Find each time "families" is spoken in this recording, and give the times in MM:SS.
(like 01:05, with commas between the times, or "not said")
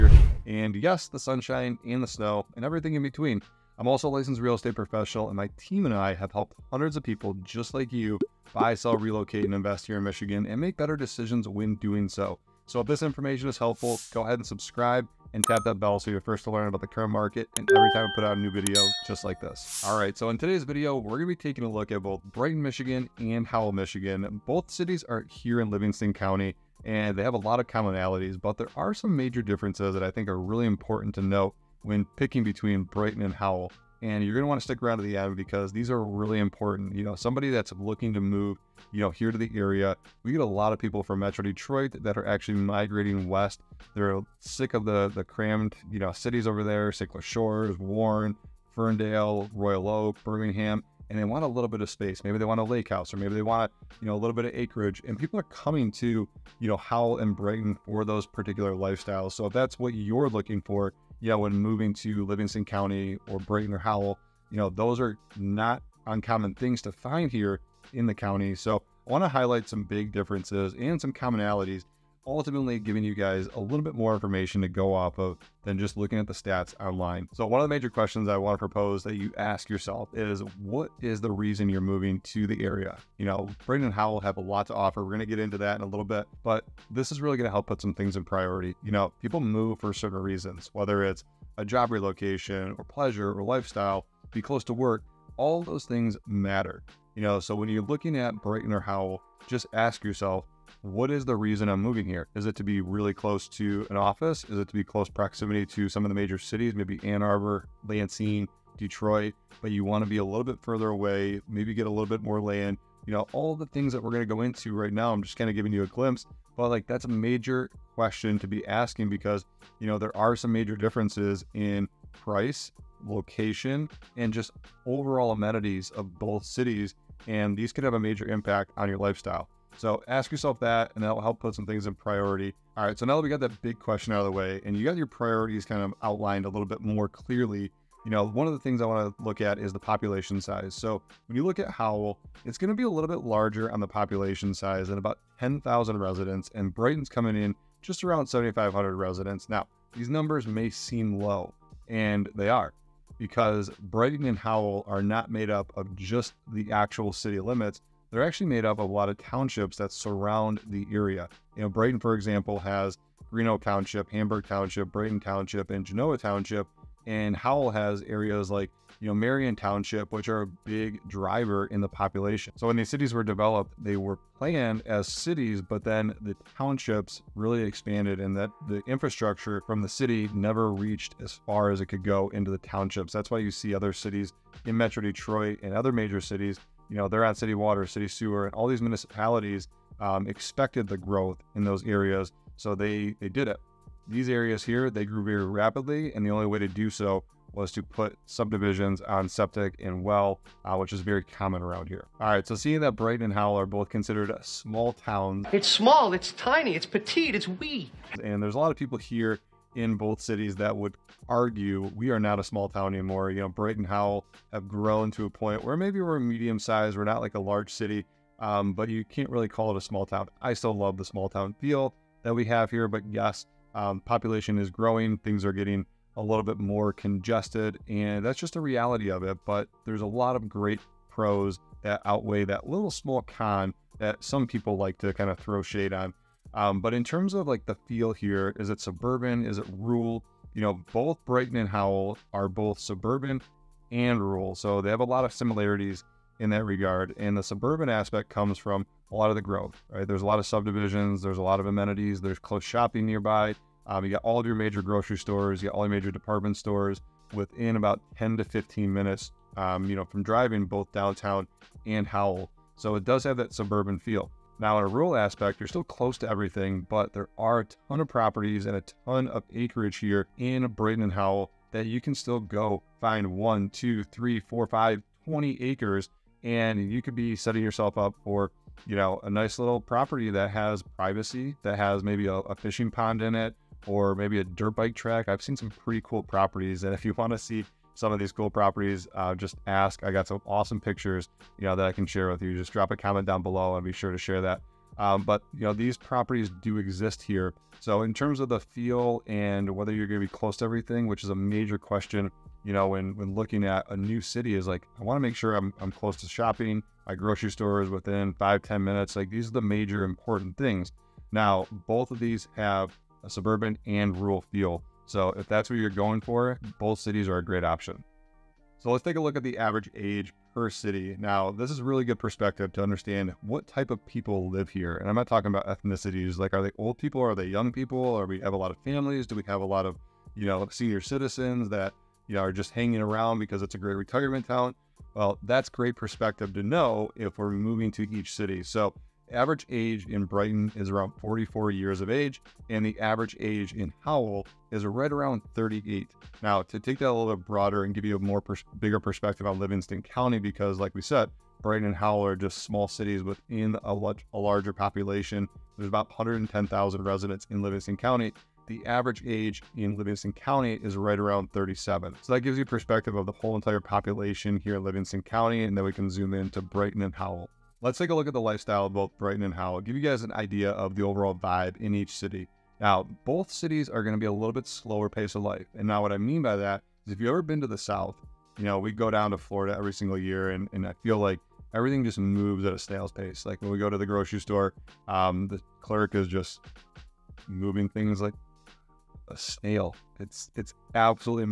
05:28.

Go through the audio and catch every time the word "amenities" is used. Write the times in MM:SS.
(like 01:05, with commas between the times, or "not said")
02:05, 04:11.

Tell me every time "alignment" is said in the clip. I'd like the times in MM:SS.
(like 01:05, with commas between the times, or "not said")
not said.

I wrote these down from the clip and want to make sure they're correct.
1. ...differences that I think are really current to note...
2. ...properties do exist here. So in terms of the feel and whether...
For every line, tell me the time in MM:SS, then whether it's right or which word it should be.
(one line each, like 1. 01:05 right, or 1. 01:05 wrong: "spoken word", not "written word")
1. 00:29 wrong: "important", not "current"
2. 04:55 right.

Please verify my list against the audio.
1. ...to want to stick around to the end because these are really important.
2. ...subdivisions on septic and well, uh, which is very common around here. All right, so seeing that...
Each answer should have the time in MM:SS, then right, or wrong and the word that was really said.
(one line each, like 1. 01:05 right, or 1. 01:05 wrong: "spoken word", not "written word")
1. 00:34 right
2. 03:18 right.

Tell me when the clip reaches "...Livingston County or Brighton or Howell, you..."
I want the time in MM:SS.
01:02.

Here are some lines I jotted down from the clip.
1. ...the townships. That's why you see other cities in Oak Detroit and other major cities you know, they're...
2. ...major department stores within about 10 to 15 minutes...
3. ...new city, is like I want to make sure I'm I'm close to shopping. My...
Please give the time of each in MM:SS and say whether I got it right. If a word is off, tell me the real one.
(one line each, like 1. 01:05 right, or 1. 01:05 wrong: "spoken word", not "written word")
1. 03:02 wrong: "Metro", not "Oak"
2. 04:15 right
3. 05:03 right.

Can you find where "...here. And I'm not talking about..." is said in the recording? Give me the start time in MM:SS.
05:24.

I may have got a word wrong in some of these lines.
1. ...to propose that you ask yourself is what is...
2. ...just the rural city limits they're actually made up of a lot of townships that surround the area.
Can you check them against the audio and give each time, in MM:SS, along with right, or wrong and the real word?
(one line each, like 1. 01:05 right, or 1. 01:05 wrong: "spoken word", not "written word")
1. 01:18 right
2. 02:35 wrong: "actual", not "rural".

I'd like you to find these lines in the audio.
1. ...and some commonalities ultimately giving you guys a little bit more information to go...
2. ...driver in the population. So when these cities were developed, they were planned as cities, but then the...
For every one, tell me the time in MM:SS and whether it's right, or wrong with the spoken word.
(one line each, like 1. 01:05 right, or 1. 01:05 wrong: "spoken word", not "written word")
1. 01:10 right
2. 02:51 right.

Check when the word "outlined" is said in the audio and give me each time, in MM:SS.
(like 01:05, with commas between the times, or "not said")
02:16.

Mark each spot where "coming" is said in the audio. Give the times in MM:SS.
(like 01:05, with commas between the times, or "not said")
00:55, 02:27.